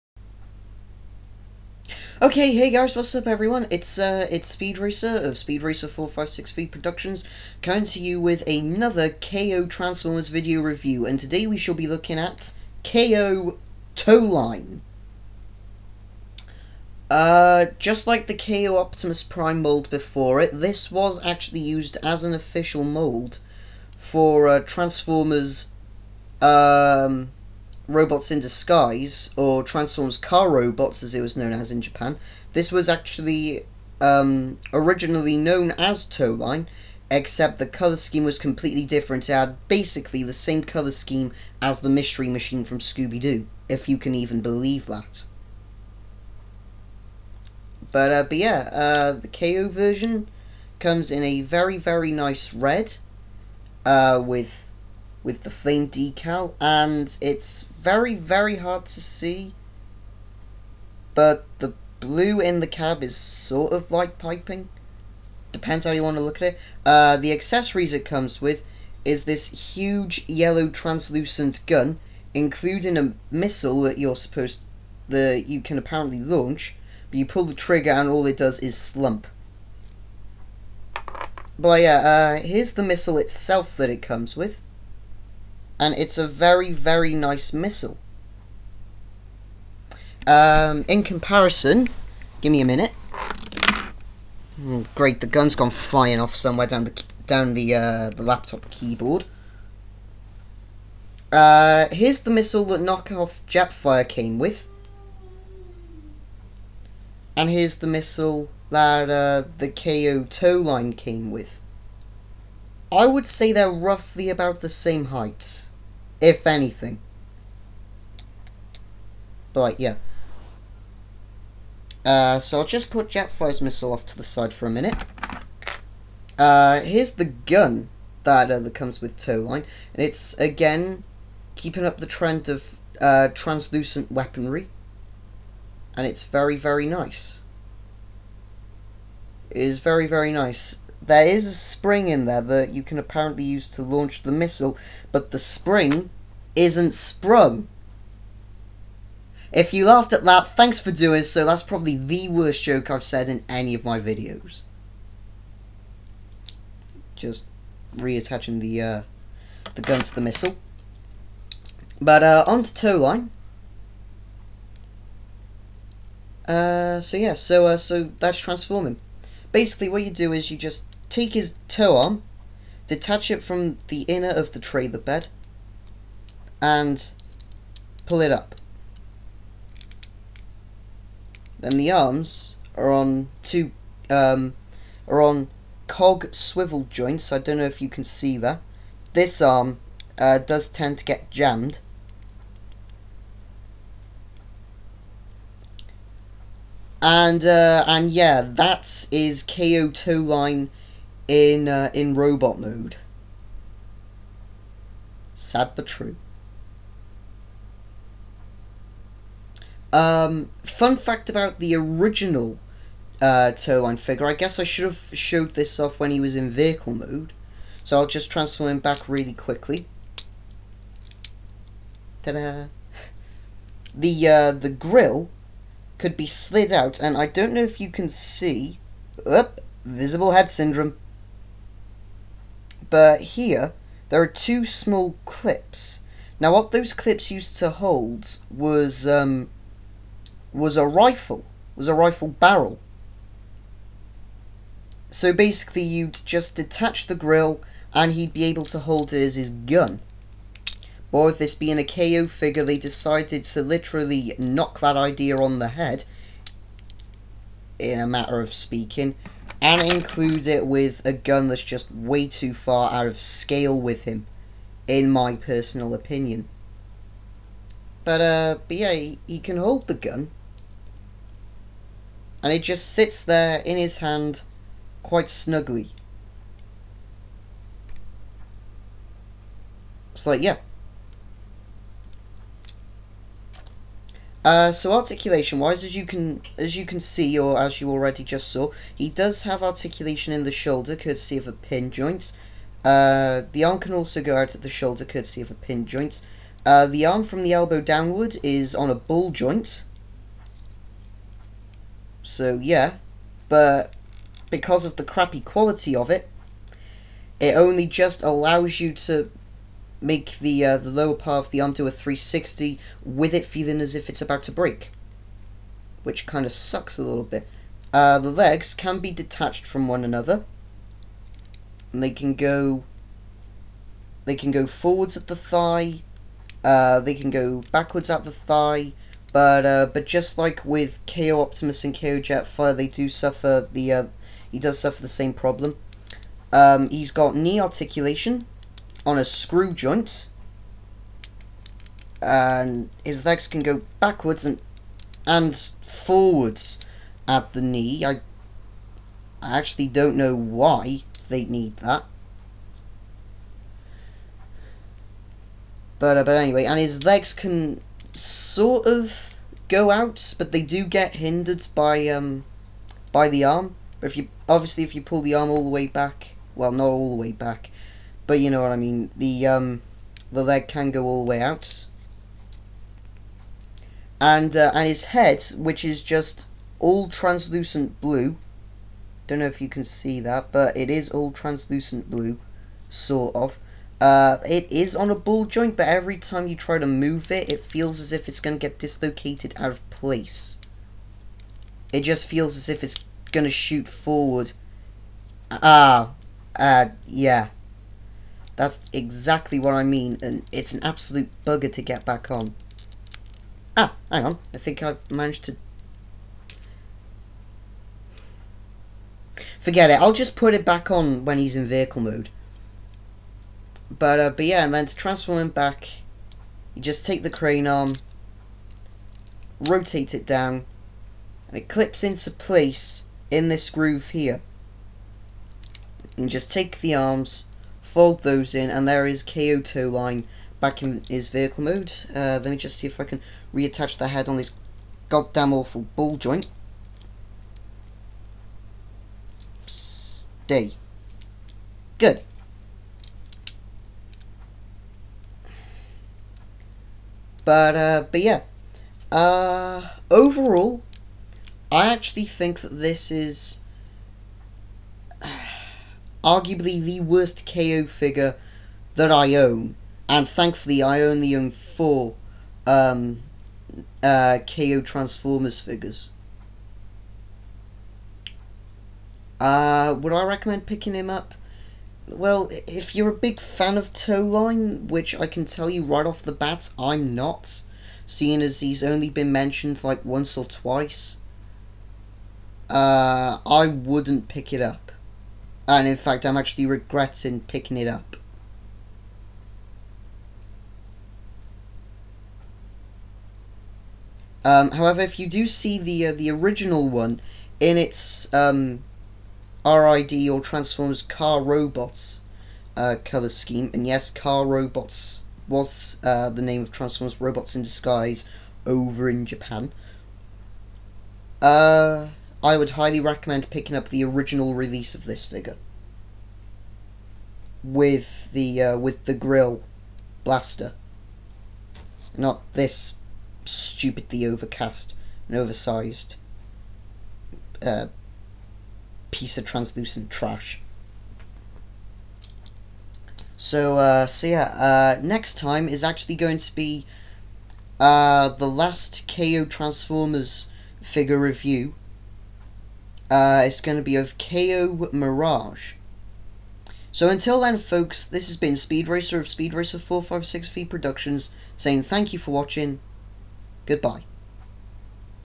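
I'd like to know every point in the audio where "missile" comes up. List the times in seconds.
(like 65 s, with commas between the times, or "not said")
73 s, 82 s, 87 s, 102 s, 107 s, 123 s, 144 s, 160 s.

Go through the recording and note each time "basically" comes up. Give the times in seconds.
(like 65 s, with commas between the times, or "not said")
39 s, 169 s, 245 s.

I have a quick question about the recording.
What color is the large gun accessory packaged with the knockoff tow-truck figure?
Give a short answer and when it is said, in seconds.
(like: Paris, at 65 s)
Yellow translucent, at 70 s.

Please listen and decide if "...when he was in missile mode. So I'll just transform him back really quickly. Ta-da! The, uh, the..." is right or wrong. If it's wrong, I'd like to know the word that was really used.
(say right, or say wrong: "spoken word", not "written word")
wrong: "vehicle", not "missile".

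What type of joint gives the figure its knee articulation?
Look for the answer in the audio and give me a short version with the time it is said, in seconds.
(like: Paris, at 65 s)
Screw joint, at 339 s.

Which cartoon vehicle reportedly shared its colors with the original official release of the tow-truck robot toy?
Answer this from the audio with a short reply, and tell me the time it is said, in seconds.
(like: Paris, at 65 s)
Mystery Machine, at 41 s.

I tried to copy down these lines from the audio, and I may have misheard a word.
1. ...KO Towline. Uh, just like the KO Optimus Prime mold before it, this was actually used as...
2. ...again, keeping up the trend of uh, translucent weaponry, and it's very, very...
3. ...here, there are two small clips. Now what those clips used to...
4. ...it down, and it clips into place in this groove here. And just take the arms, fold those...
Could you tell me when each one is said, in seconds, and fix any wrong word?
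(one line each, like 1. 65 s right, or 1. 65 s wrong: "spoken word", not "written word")
1. 12 s right
2. 130 s right
3. 233 s right
4. 420 s right.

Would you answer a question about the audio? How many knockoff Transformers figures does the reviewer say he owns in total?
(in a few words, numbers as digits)
4.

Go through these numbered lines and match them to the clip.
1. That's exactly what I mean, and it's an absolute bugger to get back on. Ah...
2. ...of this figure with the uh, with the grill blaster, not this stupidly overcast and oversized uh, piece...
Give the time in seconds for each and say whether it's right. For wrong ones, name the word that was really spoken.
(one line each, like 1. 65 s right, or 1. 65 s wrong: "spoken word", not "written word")
1. 398 s right
2. 514 s right.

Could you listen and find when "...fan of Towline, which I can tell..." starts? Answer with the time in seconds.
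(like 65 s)
473 s.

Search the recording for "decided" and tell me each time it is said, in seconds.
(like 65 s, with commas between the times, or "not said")
252 s.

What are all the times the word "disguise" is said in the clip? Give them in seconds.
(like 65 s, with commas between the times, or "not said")
28 s, 507 s.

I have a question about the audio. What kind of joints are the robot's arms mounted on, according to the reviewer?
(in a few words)
Cog swivel joints.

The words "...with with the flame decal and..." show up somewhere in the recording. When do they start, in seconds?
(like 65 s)
54 s.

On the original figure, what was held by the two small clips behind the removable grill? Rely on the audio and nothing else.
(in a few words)
A rifle barrel.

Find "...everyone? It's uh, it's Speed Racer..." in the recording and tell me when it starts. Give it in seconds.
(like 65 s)
3 s.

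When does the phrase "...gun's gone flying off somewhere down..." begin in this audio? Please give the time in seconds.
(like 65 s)
95 s.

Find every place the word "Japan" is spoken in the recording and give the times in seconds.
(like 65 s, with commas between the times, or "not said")
31 s, 509 s.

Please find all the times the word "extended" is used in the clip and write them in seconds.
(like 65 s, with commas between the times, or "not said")
not said.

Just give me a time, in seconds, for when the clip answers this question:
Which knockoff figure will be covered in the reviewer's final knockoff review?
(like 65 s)
544 s.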